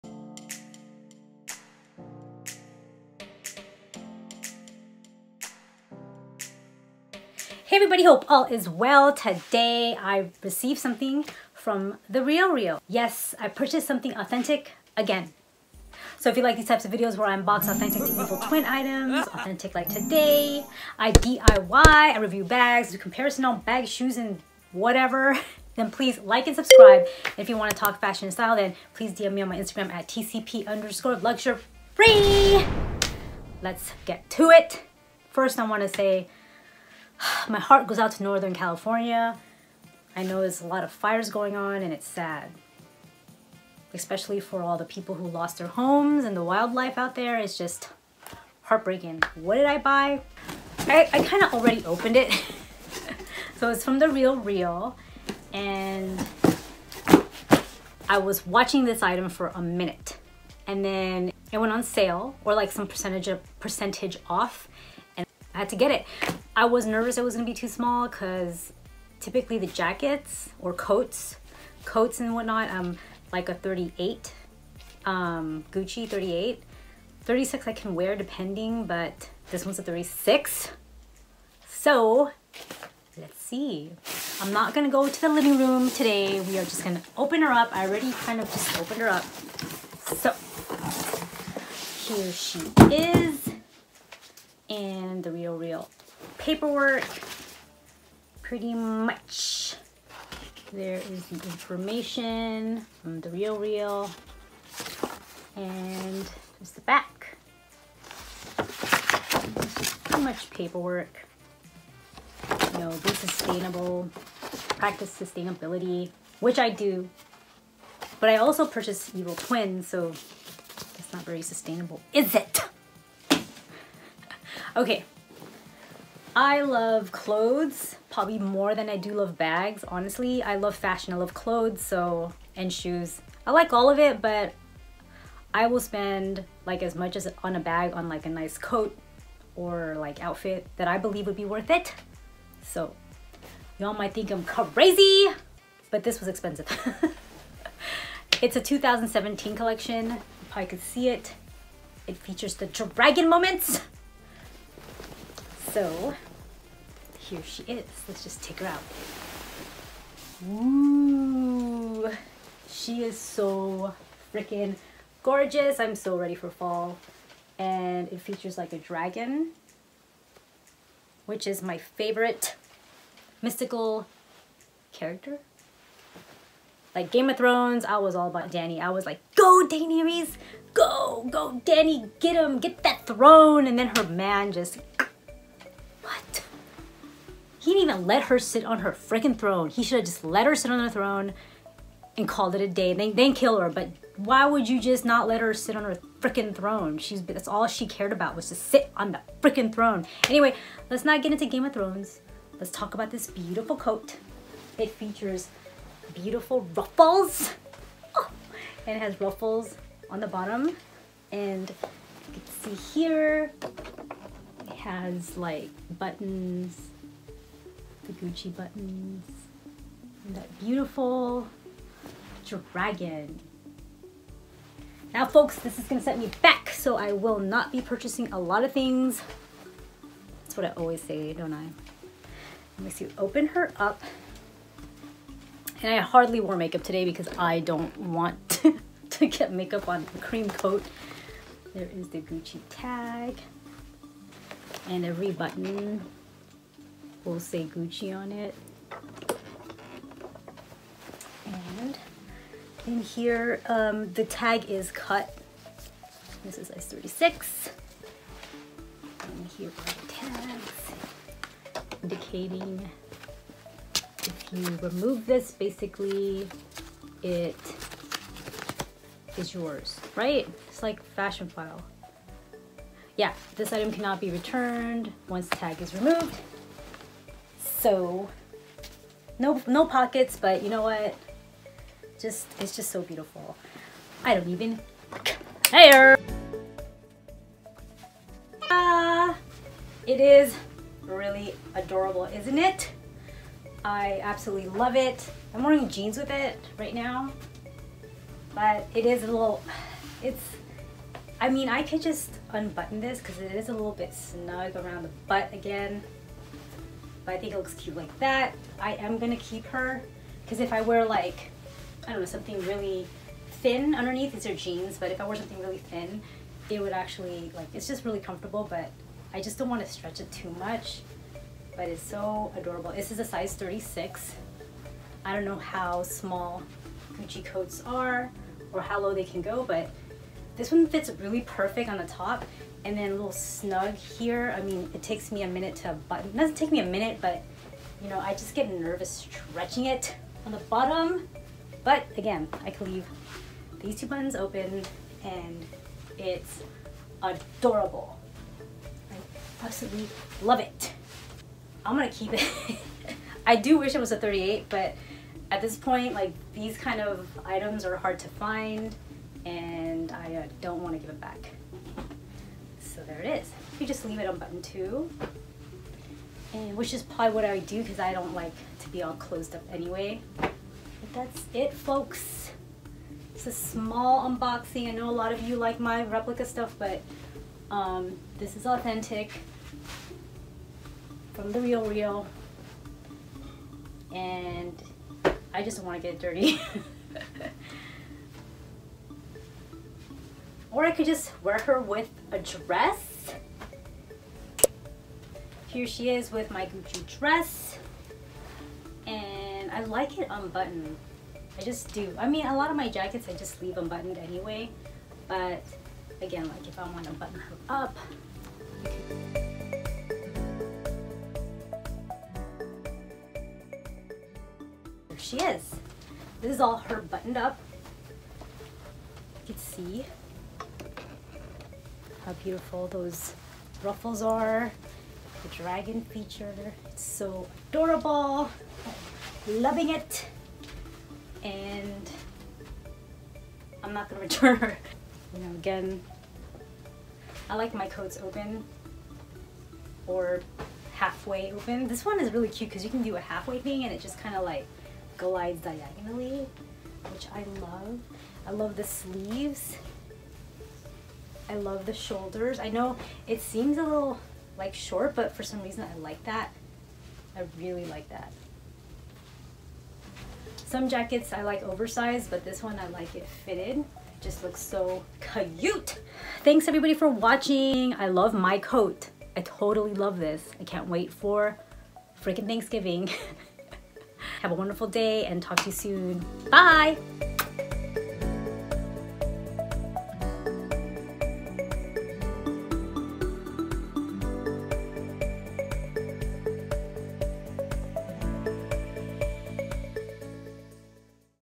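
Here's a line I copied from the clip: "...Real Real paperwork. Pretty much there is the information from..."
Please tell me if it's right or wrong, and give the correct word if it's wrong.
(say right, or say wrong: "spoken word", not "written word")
right.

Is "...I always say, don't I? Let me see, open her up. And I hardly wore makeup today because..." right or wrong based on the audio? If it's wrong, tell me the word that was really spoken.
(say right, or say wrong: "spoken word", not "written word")
right.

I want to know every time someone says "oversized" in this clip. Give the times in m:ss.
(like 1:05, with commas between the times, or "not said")
7:41.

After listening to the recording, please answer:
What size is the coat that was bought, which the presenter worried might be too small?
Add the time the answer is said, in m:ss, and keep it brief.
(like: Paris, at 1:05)
36, at 1:19.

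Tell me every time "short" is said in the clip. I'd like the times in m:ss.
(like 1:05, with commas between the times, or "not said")
7:34.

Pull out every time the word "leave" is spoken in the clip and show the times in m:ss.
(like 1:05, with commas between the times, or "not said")
5:42, 6:04, 6:43.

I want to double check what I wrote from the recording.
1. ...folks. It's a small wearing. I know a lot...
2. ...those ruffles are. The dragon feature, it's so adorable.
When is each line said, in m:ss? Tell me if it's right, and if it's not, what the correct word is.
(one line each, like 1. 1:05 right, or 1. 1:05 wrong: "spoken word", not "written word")
1. 6:11 wrong: "unboxing", not "wearing"
2. 7:02 right.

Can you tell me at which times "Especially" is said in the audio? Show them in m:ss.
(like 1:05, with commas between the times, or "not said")
0:43.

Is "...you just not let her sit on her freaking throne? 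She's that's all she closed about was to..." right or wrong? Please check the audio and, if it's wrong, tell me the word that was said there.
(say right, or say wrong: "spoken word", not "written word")
wrong: "cared", not "closed".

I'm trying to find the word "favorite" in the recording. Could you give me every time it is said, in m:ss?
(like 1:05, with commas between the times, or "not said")
2:51.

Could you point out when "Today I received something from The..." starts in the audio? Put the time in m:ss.
0:09.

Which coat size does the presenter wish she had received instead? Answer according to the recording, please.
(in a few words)
38.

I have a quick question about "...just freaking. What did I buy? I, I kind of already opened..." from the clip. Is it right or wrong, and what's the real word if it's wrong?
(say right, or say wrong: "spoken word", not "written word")
wrong: "heartbreaking", not "freaking".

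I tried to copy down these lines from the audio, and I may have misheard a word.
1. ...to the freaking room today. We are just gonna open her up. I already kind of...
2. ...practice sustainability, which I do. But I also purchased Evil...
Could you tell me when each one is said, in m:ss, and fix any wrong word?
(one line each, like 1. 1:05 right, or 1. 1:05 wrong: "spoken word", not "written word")
1. 1:25 wrong: "living", not "freaking"
2. 1:54 right.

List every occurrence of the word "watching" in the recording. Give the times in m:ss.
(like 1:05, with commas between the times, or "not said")
0:58, 7:47.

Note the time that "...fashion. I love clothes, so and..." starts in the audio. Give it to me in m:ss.
2:10.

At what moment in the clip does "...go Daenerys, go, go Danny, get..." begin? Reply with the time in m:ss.
2:59.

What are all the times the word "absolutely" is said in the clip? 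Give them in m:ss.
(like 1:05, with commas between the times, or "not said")
4:54, 5:49.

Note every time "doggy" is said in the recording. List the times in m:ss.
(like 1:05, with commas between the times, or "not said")
not said.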